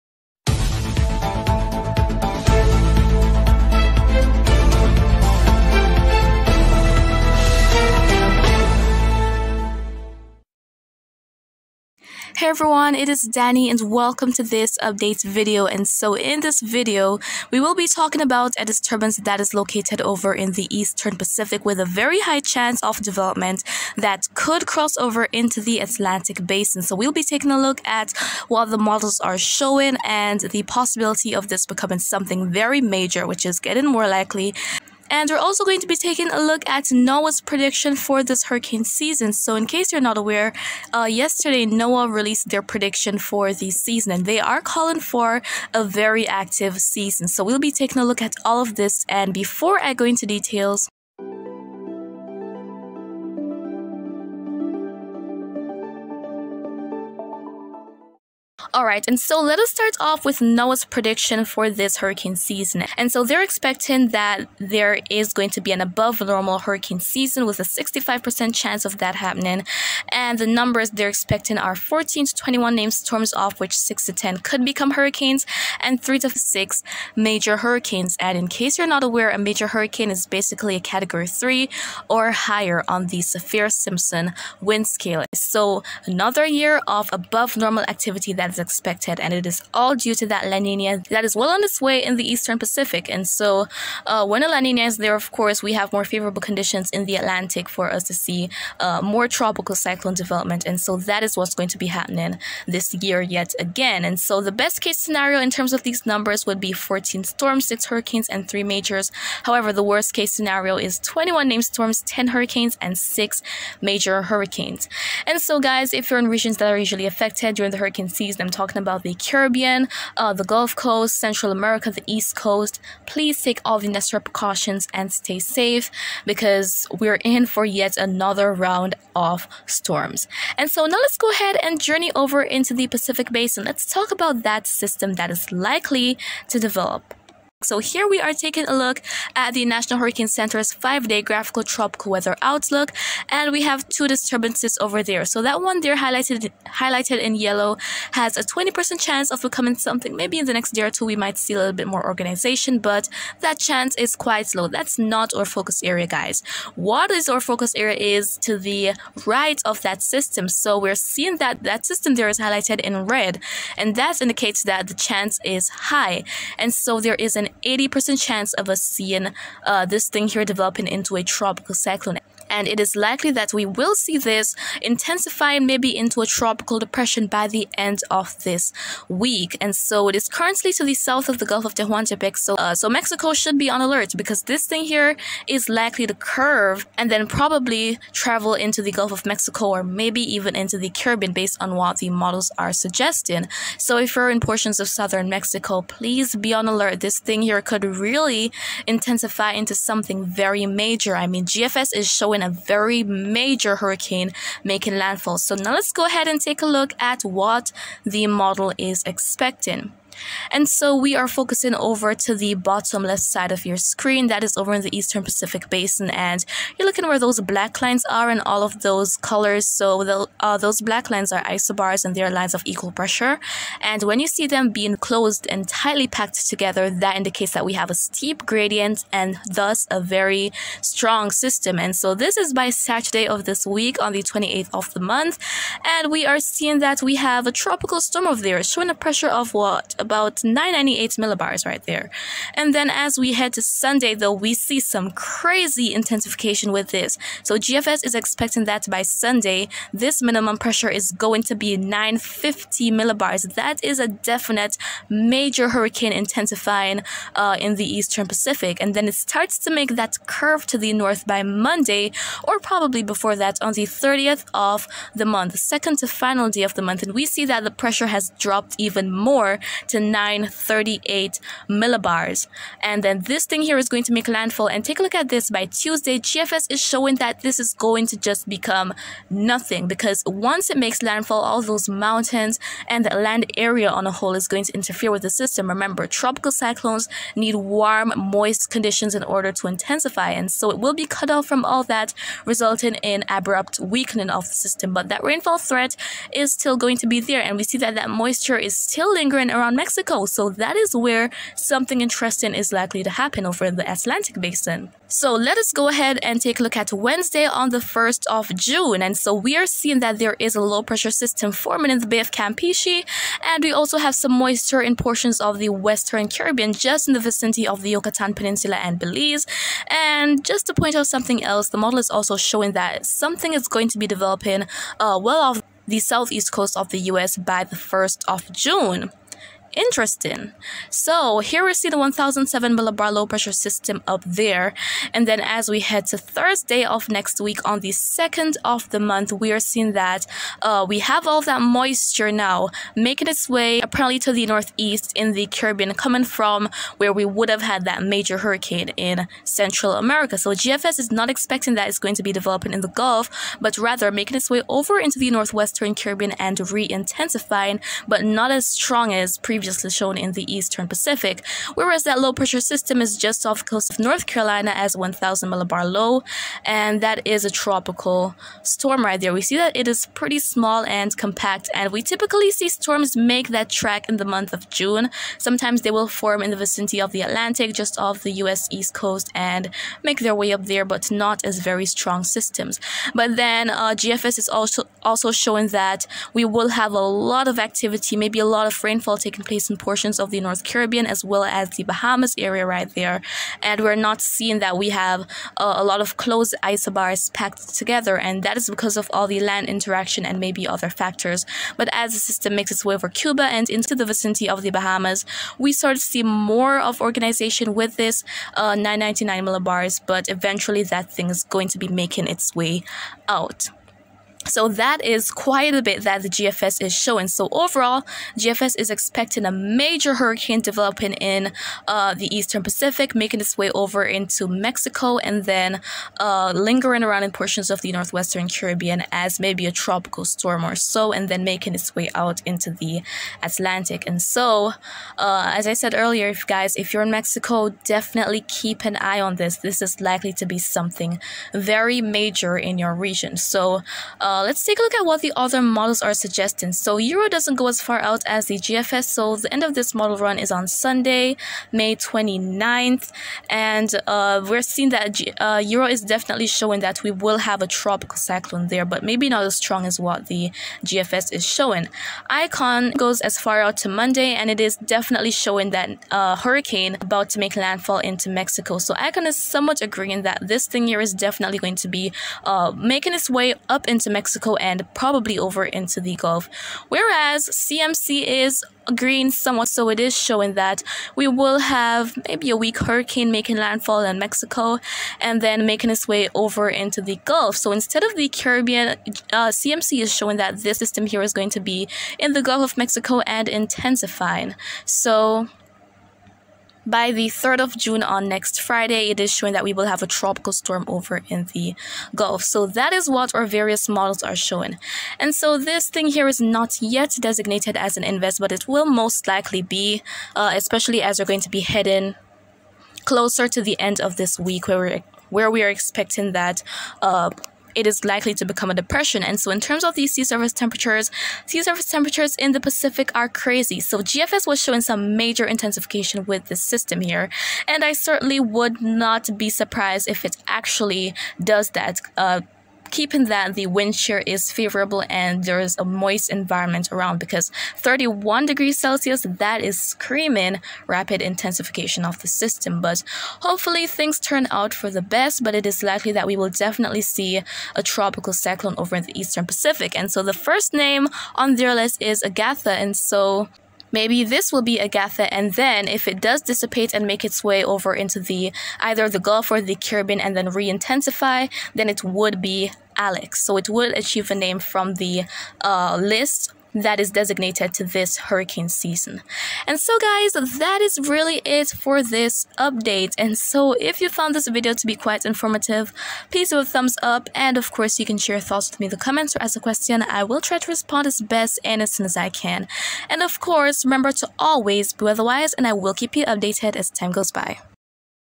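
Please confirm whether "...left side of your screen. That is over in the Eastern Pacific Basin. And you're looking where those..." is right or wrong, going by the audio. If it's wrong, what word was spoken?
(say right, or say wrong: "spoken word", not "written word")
right.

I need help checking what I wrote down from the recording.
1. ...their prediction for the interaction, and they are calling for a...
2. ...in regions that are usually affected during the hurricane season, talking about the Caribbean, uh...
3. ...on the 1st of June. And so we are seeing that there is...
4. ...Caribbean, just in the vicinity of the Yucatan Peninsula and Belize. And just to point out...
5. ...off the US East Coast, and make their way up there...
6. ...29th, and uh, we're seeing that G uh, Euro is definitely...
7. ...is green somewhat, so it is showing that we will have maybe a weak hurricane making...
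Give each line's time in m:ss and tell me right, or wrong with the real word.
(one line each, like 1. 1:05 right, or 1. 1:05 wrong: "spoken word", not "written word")
1. 0:42 wrong: "season", not "interaction"
2. 1:56 right
3. 5:07 right
4. 5:16 right
5. 6:17 right
6. 7:31 right
7. 7:58 right.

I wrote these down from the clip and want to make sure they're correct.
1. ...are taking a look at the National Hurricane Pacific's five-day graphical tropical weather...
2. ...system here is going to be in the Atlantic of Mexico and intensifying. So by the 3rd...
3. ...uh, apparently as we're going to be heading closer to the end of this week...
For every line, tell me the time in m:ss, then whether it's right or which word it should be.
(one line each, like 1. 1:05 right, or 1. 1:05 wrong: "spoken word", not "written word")
1. 2:18 wrong: "Center", not "Pacific"
2. 8:10 wrong: "Gulf", not "Atlantic"
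3. 8:30 wrong: "especially", not "apparently".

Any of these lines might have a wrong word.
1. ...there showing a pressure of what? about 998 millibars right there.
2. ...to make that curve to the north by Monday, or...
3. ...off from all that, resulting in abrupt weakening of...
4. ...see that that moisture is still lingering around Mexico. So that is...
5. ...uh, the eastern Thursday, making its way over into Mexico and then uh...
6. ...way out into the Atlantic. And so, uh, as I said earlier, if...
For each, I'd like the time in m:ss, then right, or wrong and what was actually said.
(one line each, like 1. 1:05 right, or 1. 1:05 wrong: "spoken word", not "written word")
1. 3:58 right
2. 4:19 right
3. 4:51 right
4. 4:57 right
5. 7:01 wrong: "Pacific", not "Thursday"
6. 7:11 right.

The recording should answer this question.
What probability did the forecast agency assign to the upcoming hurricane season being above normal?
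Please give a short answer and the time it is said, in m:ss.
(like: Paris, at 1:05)
65%, at 1:07.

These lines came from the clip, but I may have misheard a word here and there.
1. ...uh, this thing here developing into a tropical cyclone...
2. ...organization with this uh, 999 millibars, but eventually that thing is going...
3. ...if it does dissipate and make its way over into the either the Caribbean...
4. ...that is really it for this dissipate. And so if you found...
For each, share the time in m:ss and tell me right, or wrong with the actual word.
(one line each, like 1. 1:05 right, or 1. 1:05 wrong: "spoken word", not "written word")
1. 2:49 right
2. 6:47 right
3. 9:15 wrong: "Gulf", not "Caribbean"
4. 9:30 wrong: "update", not "dissipate".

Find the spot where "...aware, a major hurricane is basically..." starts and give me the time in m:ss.
1:19.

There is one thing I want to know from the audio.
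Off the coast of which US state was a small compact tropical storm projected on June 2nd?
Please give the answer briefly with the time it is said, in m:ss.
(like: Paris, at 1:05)
North Carolina, at 6:03.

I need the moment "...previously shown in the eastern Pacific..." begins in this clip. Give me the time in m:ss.
5:59.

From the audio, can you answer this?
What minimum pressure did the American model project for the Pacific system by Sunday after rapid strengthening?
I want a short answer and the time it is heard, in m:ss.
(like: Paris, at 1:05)
950 millibars, at 4:11.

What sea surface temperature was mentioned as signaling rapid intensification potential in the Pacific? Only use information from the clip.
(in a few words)
31 degrees Celsius.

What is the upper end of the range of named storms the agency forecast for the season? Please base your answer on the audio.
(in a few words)
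21.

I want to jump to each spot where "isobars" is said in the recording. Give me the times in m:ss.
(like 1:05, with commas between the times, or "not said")
3:41, 6:36.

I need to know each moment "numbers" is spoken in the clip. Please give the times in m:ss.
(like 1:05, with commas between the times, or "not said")
1:10, 1:46.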